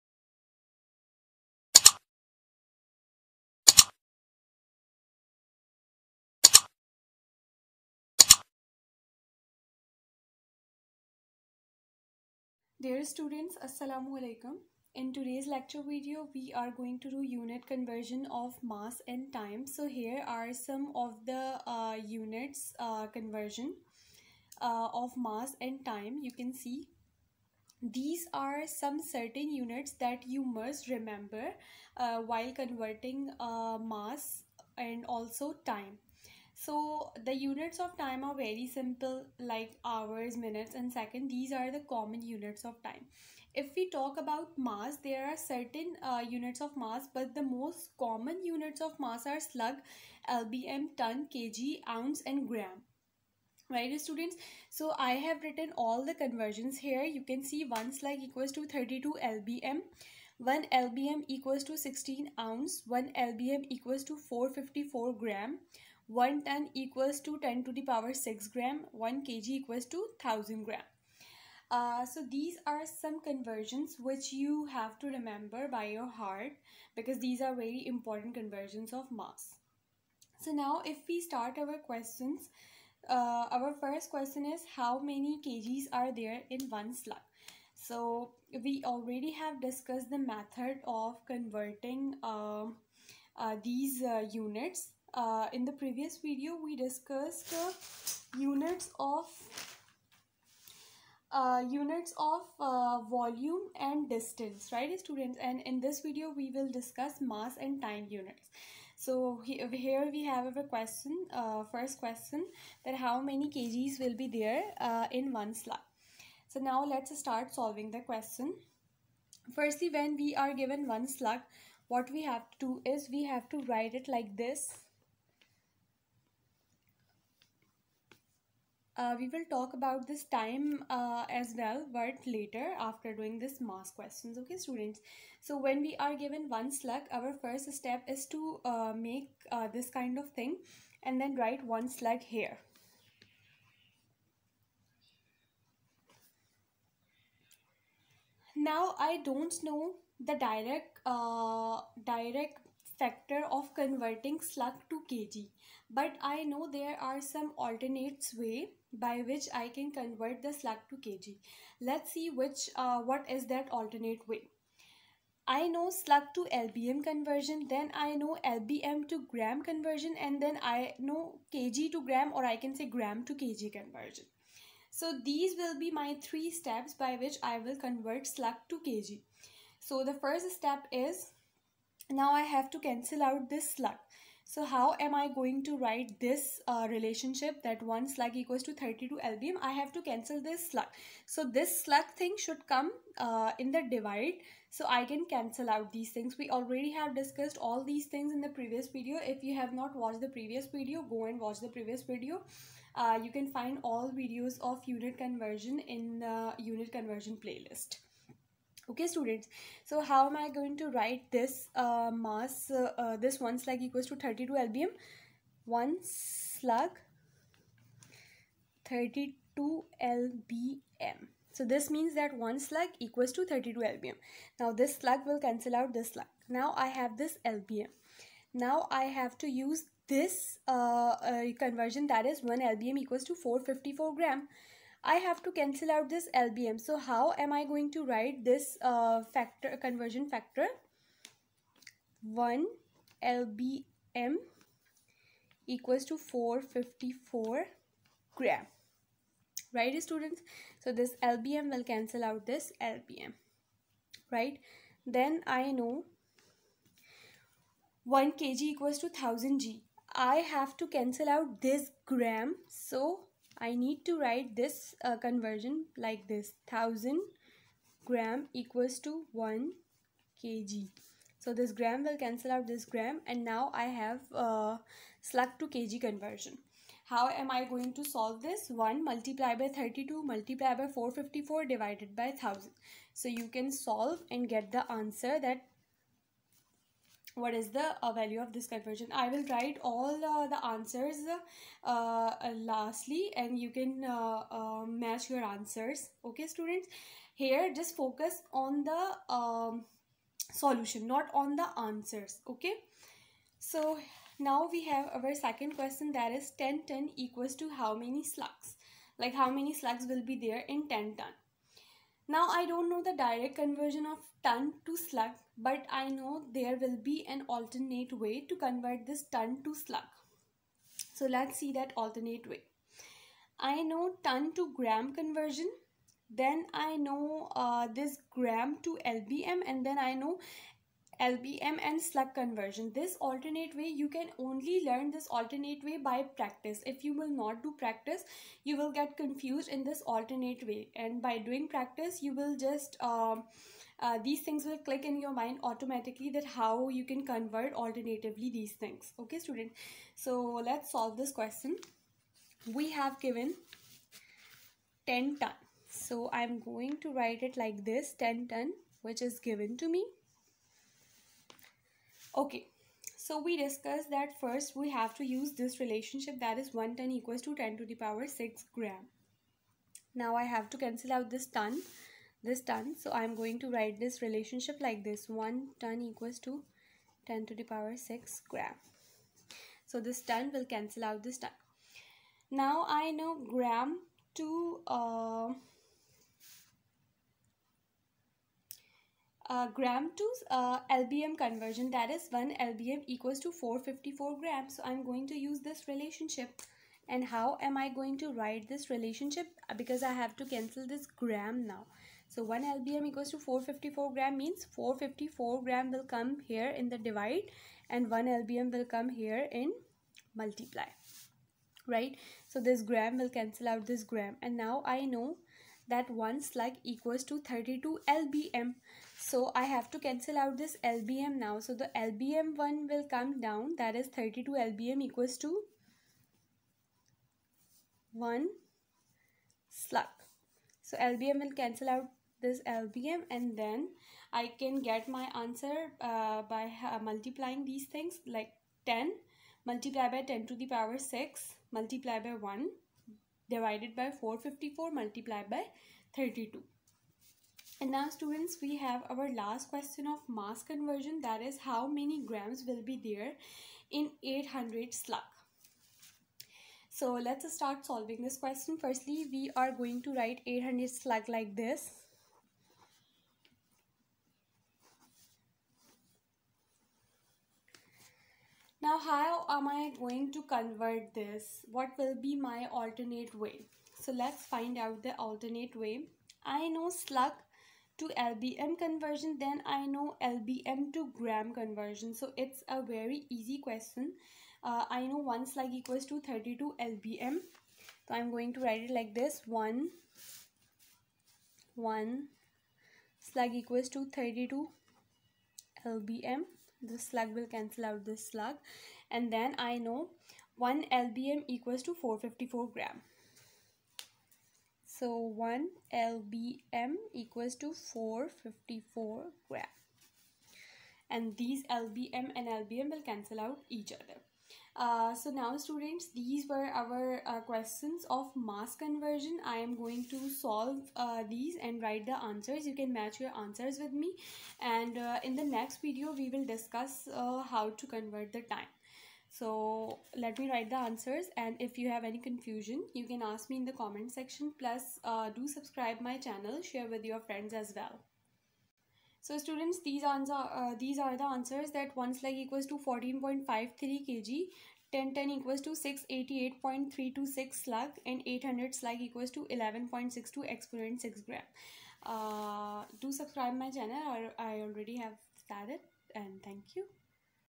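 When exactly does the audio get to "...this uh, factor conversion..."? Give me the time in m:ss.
3:58.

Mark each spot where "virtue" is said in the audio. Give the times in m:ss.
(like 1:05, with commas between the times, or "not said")
not said.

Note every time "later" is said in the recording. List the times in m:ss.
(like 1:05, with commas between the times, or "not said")
2:12.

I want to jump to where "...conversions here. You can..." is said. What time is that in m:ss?
0:56.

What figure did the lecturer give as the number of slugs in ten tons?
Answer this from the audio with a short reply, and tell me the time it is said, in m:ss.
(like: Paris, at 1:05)
688.326, at 9:05.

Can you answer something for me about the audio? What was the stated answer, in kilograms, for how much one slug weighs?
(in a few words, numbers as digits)
14.53 kg.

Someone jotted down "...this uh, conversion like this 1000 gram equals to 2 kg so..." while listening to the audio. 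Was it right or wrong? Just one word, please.
wrong.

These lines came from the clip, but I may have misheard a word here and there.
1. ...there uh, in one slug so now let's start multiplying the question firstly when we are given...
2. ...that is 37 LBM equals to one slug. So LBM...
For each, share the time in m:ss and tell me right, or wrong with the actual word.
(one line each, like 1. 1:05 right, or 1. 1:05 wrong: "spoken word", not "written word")
1. 1:54 wrong: "solving", not "multiplying"
2. 7:03 wrong: "32", not "37".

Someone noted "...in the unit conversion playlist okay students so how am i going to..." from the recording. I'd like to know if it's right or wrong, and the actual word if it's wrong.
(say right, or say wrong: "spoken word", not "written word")
right.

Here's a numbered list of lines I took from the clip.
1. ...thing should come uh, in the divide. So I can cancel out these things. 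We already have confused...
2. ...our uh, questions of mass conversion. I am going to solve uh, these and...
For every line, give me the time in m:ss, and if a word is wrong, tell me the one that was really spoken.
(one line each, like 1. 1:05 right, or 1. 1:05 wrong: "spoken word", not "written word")
1. 3:12 wrong: "discussed", not "confused"
2. 8:36 right.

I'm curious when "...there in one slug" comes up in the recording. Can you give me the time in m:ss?
1:26.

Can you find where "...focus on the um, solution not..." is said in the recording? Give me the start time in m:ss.
4:57.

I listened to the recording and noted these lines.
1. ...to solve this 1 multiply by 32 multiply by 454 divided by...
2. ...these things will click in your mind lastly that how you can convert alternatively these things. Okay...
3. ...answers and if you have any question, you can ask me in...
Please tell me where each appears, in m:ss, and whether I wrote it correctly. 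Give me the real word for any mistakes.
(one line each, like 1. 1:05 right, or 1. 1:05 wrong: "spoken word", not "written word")
1. 4:37 right
2. 5:44 wrong: "automatically", not "lastly"
3. 8:50 wrong: "confusion", not "question".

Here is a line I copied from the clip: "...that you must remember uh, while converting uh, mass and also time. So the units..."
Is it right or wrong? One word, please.
right.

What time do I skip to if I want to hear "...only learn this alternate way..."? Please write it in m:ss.
5:34.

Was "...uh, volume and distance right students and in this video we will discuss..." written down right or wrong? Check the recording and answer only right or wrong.
right.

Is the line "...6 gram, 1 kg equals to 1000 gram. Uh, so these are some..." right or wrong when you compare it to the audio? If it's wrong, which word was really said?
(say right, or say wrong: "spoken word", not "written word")
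right.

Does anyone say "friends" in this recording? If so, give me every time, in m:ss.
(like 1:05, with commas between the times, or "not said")
8:57.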